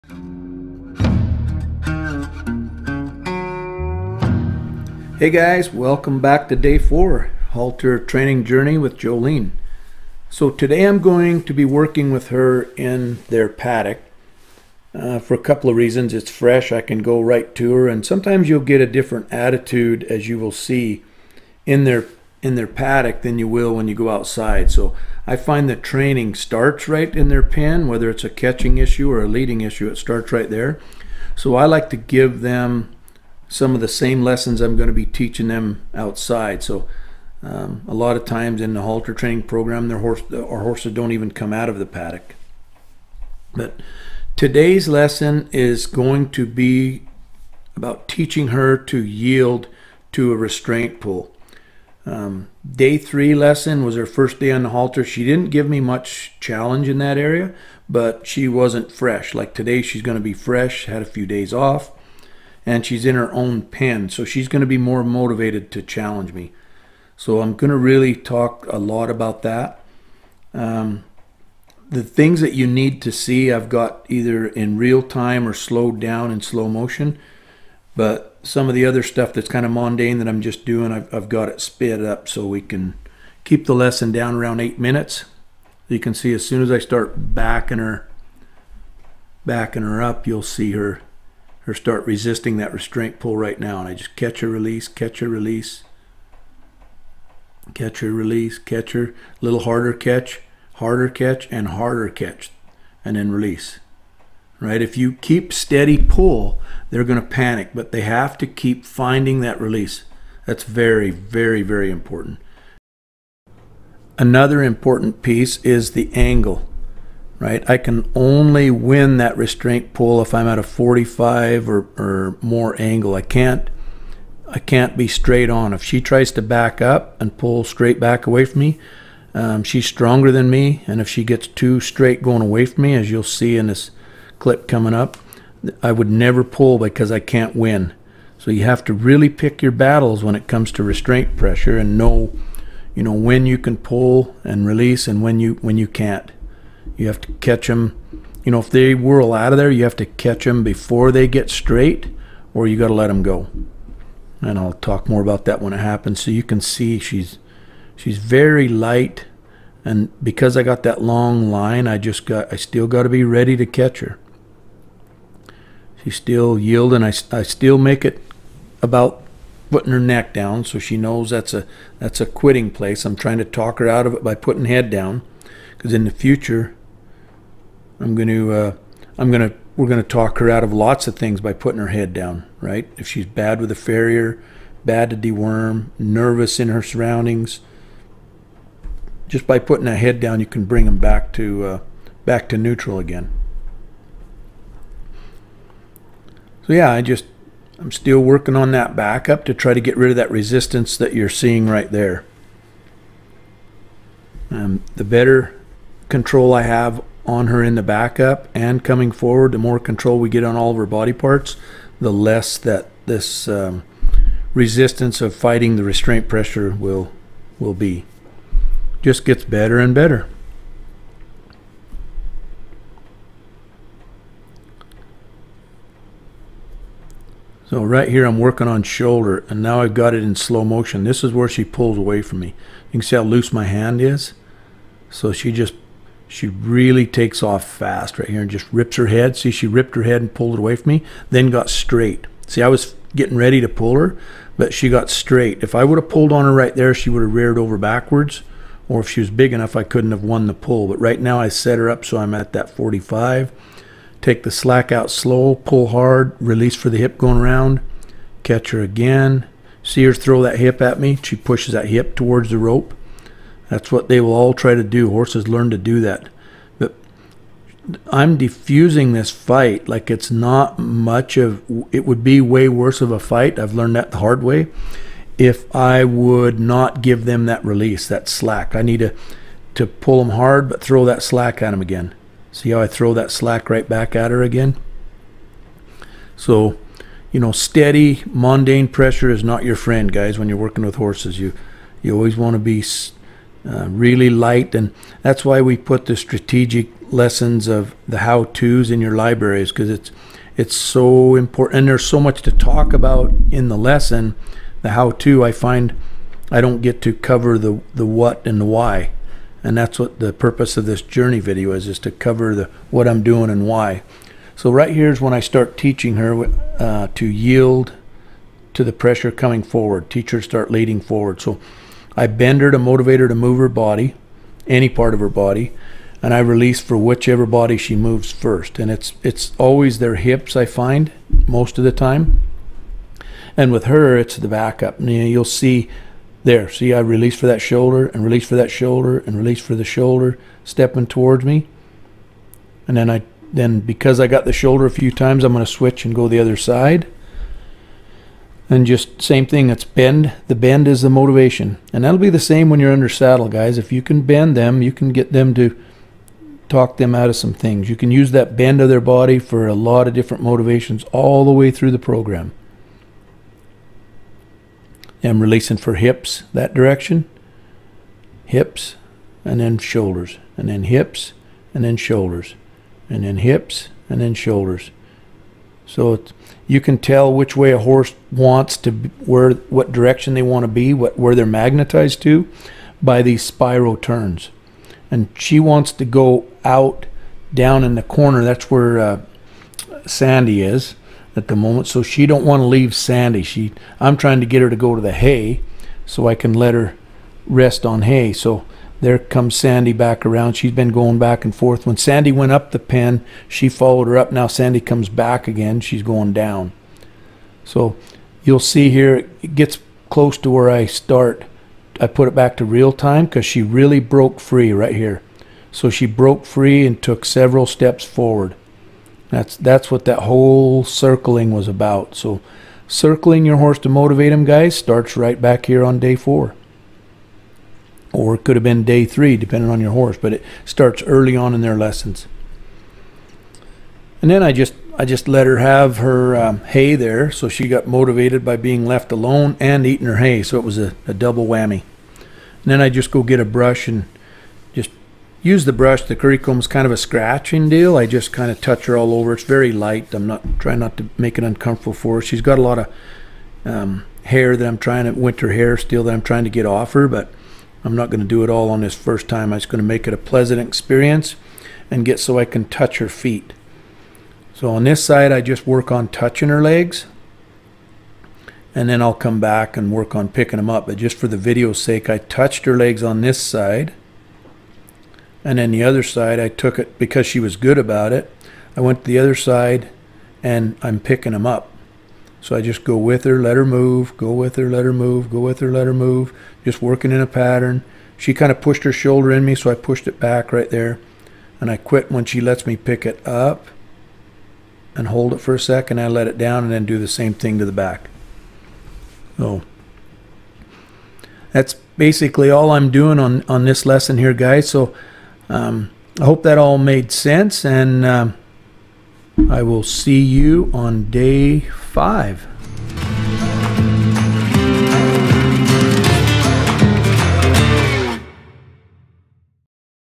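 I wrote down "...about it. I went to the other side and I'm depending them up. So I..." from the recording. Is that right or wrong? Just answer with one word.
wrong.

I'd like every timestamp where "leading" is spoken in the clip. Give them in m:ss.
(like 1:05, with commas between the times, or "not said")
0:29, 5:20.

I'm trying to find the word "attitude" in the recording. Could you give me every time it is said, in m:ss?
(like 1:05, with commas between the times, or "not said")
0:19.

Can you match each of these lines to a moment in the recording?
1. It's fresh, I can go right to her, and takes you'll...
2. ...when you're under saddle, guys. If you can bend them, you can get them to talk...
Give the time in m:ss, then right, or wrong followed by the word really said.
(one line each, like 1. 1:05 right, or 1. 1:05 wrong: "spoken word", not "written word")
1. 0:16 wrong: "sometimes", not "takes"
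2. 5:52 right.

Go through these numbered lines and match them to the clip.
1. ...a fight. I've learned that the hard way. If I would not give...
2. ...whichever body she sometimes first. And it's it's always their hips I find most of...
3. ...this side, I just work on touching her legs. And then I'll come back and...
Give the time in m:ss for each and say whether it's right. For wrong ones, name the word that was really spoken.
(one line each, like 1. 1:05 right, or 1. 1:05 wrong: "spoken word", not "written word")
1. 4:33 right
2. 5:26 wrong: "moves", not "sometimes"
3. 7:44 right.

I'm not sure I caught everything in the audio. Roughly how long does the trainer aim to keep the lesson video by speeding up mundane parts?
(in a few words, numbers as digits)
8 minutes.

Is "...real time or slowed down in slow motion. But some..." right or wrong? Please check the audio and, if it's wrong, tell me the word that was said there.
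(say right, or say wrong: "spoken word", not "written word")
right.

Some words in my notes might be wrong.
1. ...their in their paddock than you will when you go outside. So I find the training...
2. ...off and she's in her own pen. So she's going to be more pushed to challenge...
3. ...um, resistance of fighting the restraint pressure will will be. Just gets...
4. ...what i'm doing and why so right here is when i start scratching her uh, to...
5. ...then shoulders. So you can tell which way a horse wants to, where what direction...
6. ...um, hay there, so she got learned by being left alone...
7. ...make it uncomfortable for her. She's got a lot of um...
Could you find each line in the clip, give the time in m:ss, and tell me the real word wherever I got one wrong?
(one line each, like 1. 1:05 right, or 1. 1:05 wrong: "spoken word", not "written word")
1. 0:21 right
2. 1:01 wrong: "motivated", not "pushed"
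3. 3:33 right
4. 5:12 wrong: "teaching", not "scratching"
5. 6:14 right
6. 7:16 wrong: "motivated", not "learned"
7. 7:31 right.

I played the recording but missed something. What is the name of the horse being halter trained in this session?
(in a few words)
Jolene.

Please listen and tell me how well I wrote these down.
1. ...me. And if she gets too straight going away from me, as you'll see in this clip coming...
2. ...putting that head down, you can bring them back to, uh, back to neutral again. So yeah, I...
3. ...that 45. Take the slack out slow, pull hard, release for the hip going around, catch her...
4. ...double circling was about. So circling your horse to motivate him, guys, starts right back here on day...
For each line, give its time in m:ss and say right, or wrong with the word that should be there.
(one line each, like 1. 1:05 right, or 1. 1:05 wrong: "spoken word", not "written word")
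1. 2:10 right
2. 3:09 right
3. 4:12 right
4. 7:00 wrong: "whole", not "double".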